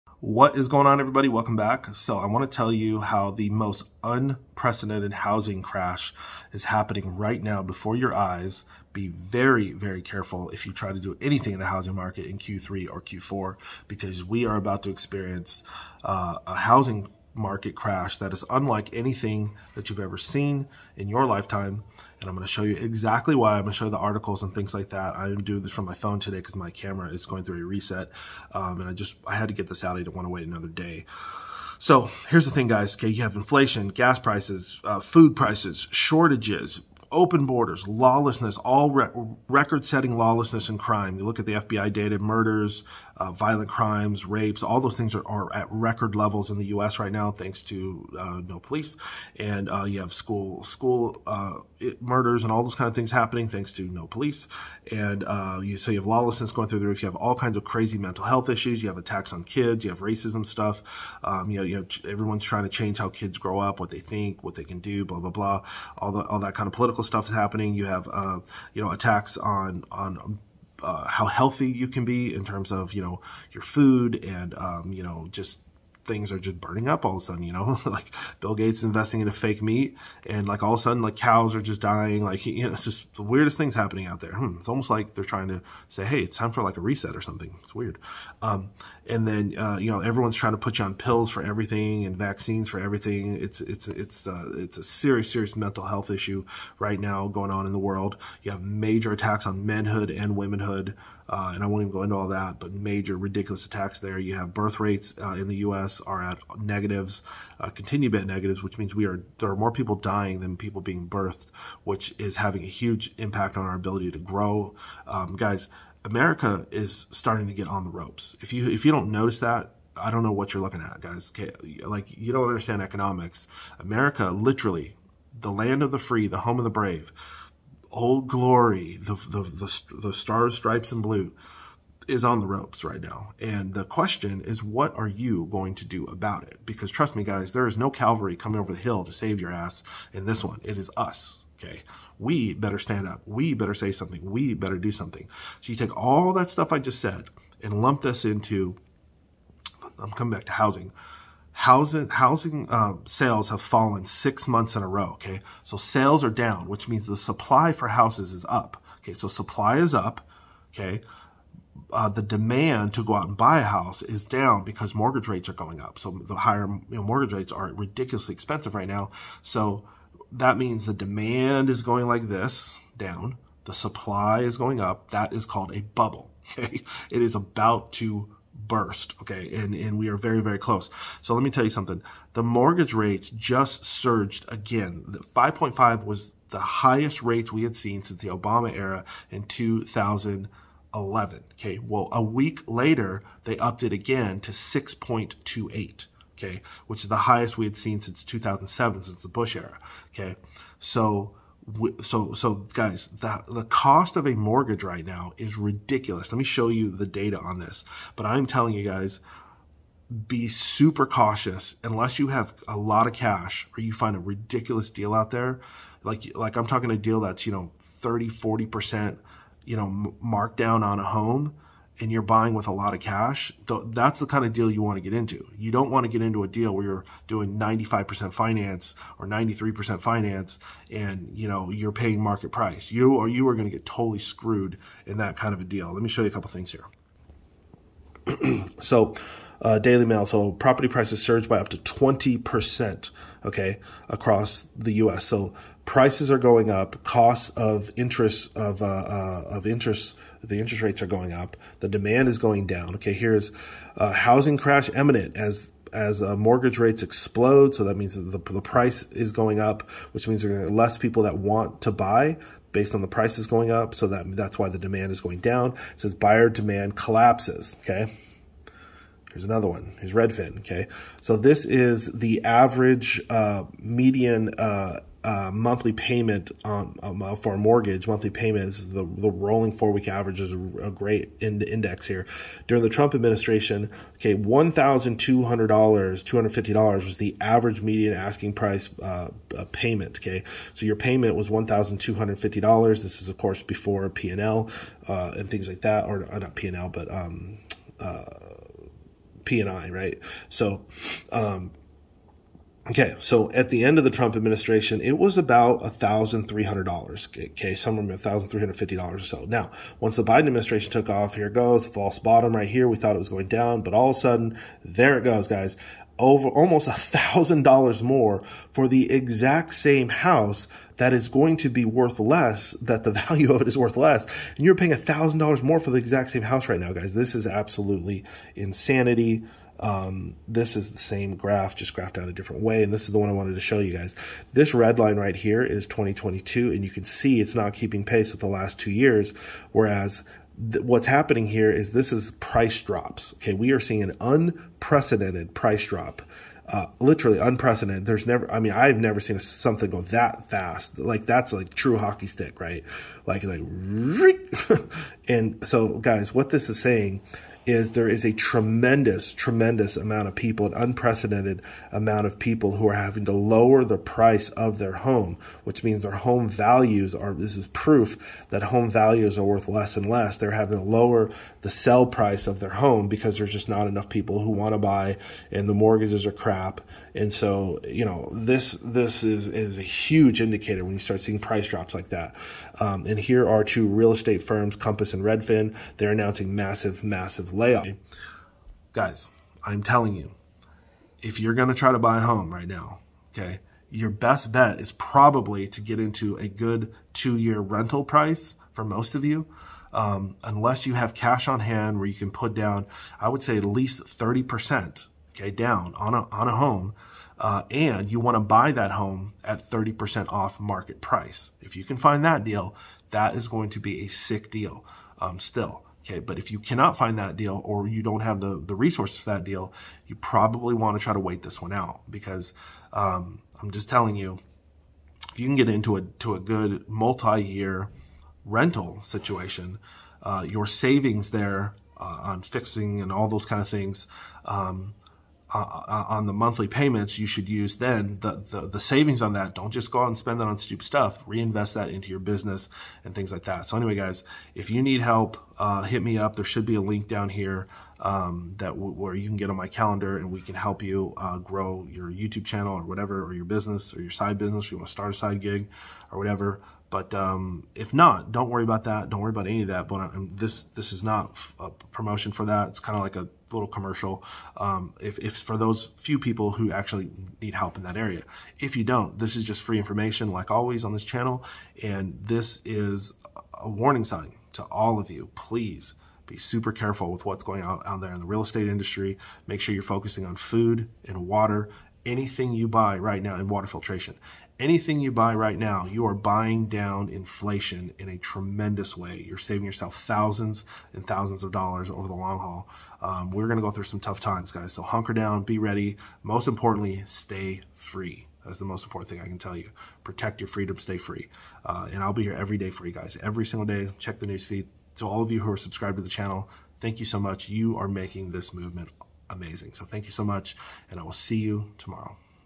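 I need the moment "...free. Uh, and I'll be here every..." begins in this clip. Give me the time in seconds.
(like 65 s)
500 s.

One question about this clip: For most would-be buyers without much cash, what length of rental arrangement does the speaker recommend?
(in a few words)
2 years.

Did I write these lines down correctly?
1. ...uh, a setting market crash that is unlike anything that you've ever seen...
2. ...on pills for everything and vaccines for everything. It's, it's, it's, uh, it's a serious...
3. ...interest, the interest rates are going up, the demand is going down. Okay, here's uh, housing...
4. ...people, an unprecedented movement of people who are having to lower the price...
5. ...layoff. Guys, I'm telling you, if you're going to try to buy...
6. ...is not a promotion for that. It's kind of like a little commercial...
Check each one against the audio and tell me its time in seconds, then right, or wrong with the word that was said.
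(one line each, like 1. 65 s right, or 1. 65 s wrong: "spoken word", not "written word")
1. 16 s wrong: "housing", not "setting"
2. 90 s right
3. 249 s right
4. 360 s wrong: "amount", not "movement"
5. 387 s right
6. 460 s right.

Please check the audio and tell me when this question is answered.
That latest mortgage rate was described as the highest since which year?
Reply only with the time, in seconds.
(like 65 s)
198 s.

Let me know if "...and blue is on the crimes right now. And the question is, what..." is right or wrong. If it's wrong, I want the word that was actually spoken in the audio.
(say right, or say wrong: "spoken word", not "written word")
wrong: "ropes", not "crimes".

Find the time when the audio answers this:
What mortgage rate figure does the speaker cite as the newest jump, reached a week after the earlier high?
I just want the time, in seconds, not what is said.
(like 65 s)
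194 s.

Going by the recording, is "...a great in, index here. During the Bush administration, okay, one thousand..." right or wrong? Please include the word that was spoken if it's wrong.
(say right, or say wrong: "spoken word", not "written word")
wrong: "Trump", not "Bush".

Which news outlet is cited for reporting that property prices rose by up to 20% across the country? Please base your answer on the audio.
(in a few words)
Daily Mail.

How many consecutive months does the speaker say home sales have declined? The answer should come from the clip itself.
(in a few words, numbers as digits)
6.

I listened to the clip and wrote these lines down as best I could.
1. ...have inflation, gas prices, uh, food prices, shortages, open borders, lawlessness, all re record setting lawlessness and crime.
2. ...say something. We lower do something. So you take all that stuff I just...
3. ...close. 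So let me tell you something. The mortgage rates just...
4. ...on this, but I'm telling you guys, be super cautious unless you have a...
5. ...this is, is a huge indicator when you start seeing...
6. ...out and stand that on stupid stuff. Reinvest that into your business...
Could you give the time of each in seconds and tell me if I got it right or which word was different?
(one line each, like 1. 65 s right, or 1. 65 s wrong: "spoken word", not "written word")
1. 33 s right
2. 143 s wrong: "better", not "lower"
3. 180 s right
4. 207 s right
5. 378 s right
6. 440 s wrong: "spend", not "stand".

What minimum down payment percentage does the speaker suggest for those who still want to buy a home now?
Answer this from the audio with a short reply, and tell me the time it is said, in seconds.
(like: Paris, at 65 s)
30%, at 403 s.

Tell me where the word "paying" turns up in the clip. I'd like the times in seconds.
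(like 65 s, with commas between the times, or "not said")
231 s, 324 s.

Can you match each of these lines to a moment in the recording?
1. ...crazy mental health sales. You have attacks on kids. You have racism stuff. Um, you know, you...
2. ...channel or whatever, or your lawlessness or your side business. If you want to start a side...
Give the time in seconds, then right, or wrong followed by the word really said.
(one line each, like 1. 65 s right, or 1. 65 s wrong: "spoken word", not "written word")
1. 57 s wrong: "issues", not "sales"
2. 452 s wrong: "business", not "lawlessness".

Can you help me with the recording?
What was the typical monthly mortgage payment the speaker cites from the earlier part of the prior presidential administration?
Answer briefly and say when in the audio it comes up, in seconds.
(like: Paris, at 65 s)
$1,250, at 291 s.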